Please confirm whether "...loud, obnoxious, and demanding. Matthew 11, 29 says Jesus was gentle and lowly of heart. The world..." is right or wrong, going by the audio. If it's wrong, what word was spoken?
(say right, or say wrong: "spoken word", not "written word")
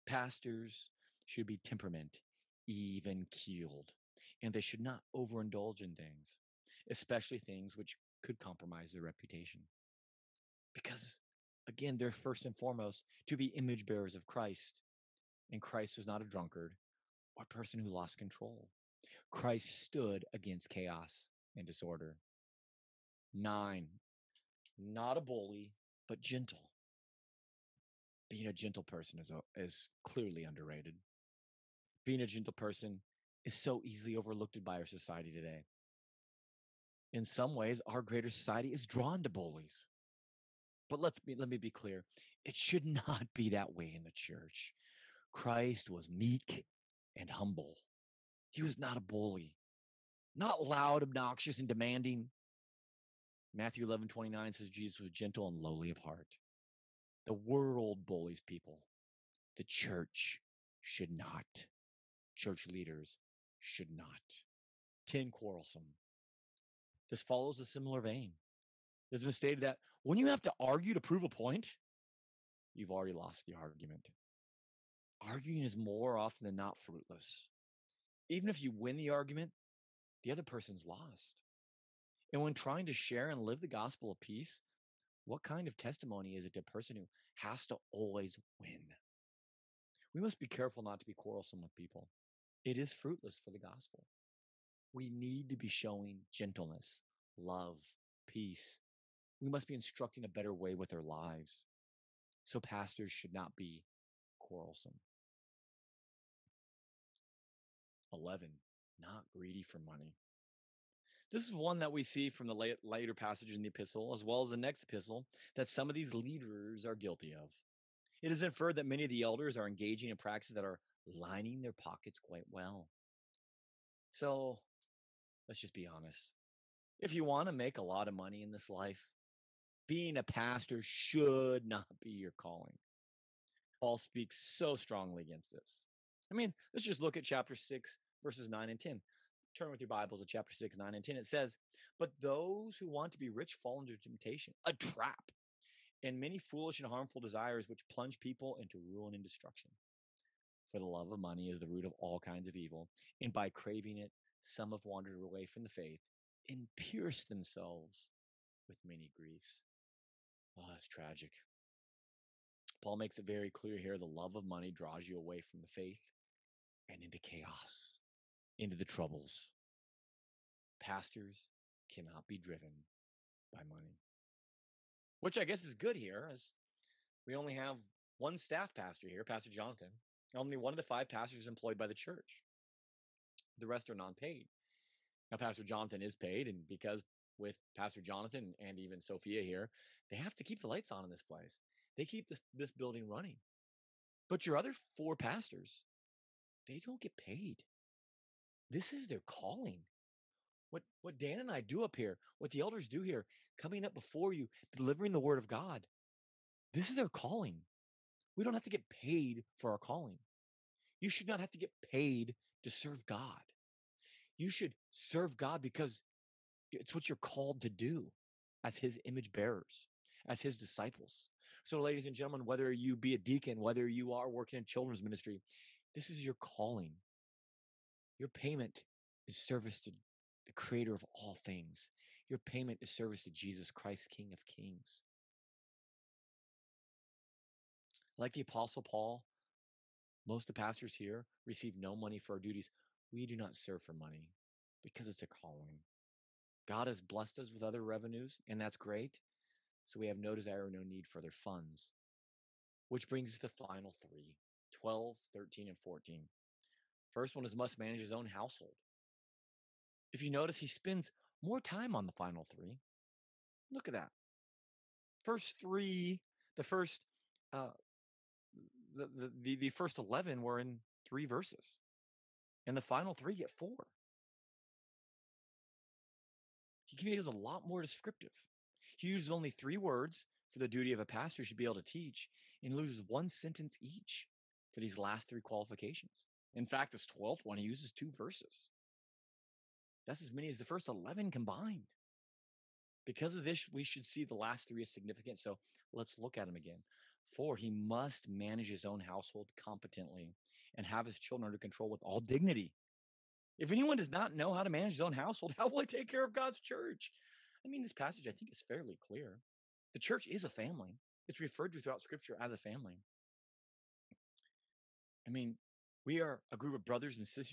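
right.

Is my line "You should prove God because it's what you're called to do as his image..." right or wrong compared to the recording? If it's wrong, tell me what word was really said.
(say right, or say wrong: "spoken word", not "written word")
wrong: "serve", not "prove".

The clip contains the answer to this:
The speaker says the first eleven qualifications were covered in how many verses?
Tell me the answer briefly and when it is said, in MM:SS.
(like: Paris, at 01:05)
3, at 04:31.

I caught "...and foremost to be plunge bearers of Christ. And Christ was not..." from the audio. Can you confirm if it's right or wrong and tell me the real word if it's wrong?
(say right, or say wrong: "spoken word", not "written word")
wrong: "image", not "plunge".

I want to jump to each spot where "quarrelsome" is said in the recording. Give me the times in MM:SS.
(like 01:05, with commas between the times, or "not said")
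01:05, 01:31, 01:44.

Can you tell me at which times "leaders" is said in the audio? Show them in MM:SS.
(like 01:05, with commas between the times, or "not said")
01:02, 01:56.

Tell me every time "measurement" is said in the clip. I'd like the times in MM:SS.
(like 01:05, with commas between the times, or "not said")
not said.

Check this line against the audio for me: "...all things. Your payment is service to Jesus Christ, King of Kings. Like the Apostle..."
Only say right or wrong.
right.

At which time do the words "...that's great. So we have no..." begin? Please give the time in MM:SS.
04:08.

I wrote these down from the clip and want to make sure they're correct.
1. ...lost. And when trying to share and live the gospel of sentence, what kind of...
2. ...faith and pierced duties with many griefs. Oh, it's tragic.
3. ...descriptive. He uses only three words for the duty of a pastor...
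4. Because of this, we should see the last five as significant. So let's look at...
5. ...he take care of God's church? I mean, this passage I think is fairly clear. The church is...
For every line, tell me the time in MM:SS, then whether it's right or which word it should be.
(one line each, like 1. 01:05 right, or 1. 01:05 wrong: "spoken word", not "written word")
1. 01:20 wrong: "peace", not "sentence"
2. 02:35 wrong: "themselves", not "duties"
3. 04:37 right
4. 04:53 wrong: "three", not "five"
5. 05:05 right.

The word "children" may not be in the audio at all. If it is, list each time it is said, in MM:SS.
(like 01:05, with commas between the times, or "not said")
03:44, 05:01.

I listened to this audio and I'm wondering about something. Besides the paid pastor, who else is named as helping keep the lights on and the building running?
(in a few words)
Sophia.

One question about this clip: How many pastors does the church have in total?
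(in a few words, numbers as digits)
5.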